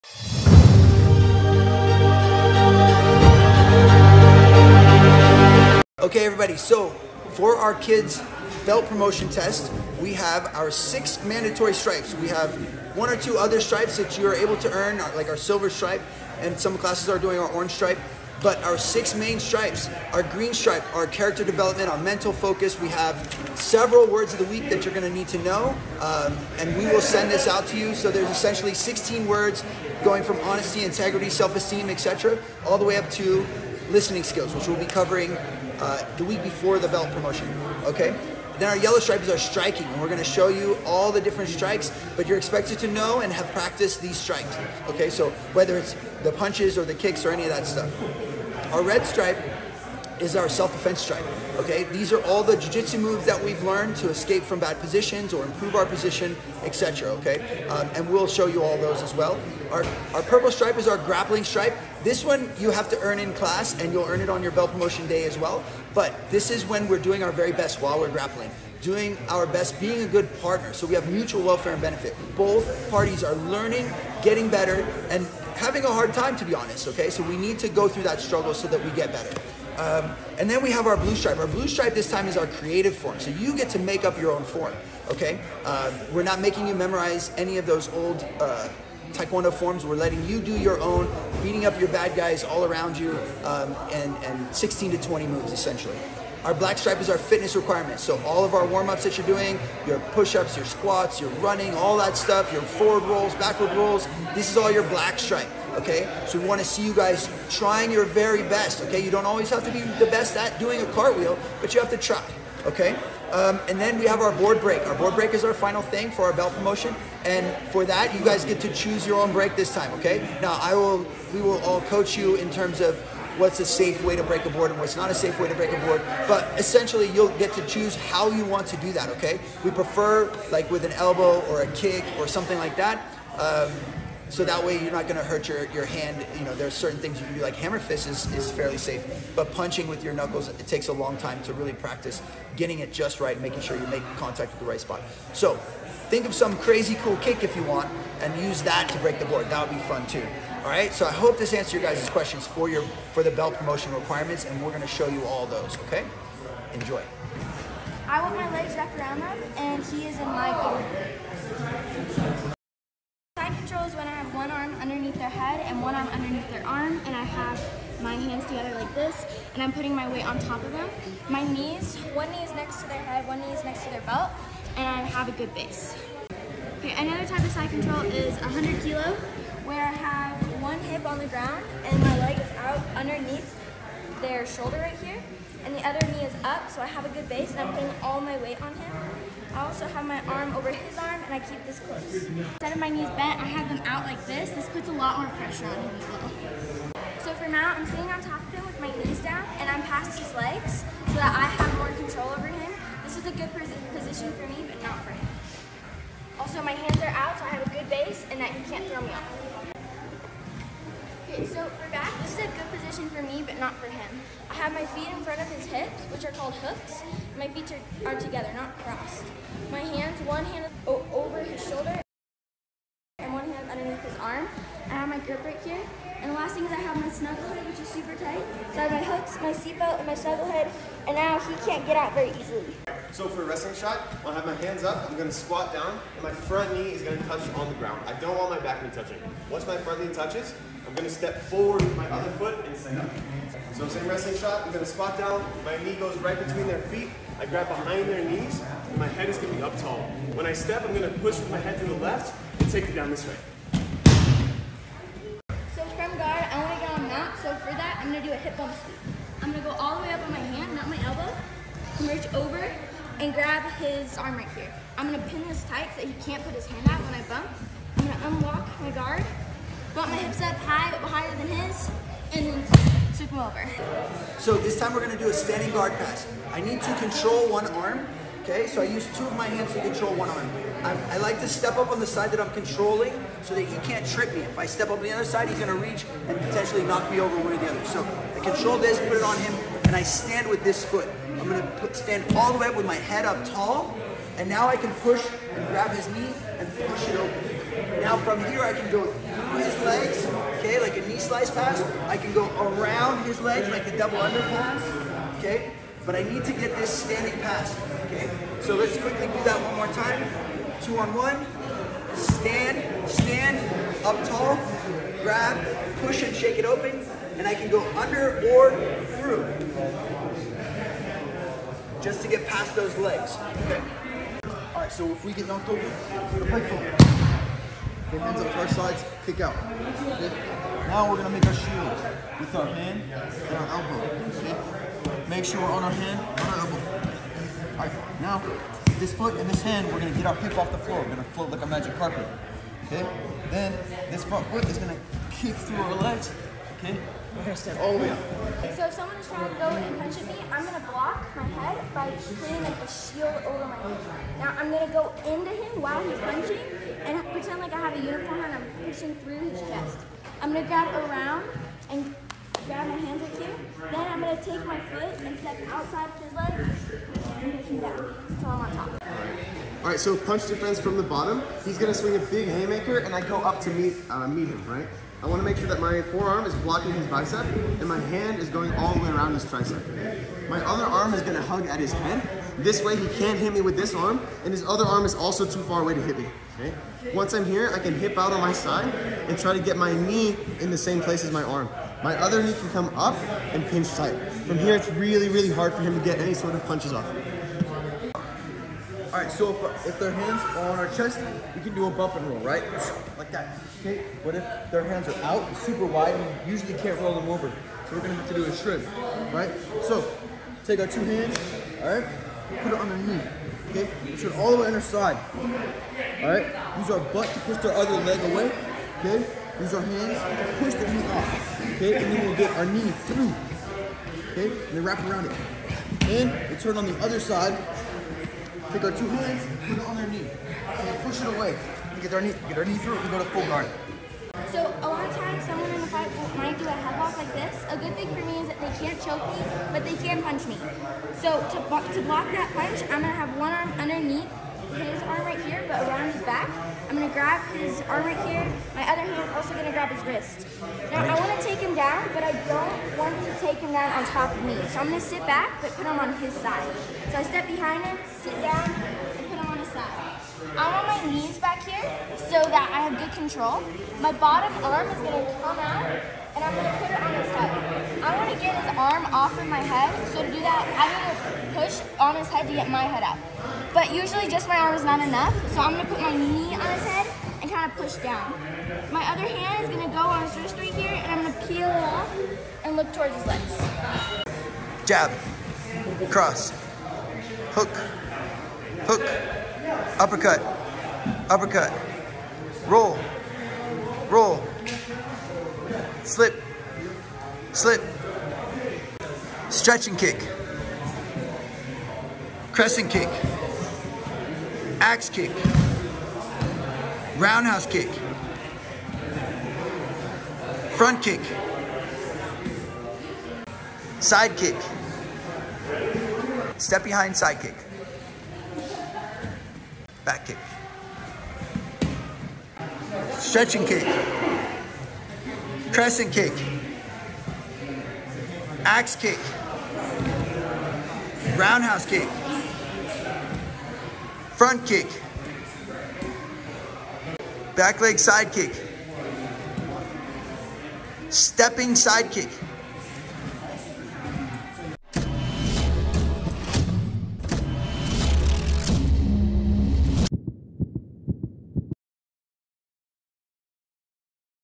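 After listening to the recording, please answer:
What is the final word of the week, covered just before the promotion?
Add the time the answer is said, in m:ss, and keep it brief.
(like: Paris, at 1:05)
Listening skills, at 0:33.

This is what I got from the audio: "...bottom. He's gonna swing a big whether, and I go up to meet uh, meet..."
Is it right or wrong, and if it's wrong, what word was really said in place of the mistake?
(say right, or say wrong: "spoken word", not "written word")
wrong: "haymaker", not "whether".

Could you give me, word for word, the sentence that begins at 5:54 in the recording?
Now I'm gonna go into him while he's punching and pretend like I have a uniform and I'm pushing through his chest.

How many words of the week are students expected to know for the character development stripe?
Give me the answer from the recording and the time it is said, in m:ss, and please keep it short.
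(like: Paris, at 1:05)
16, at 0:28.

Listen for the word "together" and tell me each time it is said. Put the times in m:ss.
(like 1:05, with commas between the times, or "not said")
2:48, 3:38.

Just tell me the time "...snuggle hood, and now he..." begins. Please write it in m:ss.
3:50.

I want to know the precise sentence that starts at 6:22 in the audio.
This way he can't hit me with this arm and his other arm is also too far away to hit me.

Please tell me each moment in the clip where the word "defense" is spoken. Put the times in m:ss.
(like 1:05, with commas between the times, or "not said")
0:50, 6:10.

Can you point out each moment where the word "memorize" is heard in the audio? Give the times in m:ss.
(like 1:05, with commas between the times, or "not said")
1:26.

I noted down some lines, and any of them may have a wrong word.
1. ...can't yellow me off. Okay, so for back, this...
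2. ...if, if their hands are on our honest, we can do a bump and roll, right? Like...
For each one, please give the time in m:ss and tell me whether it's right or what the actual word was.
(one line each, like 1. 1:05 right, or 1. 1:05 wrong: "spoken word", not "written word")
1. 3:28 wrong: "throw", not "yellow"
2. 6:39 wrong: "chest", not "honest".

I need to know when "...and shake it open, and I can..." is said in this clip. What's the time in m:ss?
5:16.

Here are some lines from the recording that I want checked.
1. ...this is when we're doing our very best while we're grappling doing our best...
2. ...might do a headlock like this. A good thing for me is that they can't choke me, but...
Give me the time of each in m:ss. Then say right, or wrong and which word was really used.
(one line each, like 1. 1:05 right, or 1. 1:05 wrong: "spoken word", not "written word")
1. 1:06 right
2. 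7:16 right.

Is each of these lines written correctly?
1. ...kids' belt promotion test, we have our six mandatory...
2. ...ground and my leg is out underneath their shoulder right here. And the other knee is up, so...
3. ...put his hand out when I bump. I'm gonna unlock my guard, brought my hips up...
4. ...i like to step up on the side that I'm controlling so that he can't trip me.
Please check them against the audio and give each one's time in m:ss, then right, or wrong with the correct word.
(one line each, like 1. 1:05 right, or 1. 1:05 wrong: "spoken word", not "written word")
1. 0:07 right
2. 3:01 right
3. 4:26 right
4. 4:41 right.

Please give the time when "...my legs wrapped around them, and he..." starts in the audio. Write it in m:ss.
2:38.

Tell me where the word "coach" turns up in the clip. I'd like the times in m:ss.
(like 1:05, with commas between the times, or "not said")
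2:01.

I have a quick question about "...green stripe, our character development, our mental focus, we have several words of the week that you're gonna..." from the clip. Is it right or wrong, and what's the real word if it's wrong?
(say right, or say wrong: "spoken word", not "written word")
right.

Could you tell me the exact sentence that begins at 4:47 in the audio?
So I control this, put it on him, and I stand with this foot.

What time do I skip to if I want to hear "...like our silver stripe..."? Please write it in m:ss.
0:15.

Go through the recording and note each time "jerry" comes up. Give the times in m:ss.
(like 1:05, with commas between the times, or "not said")
not said.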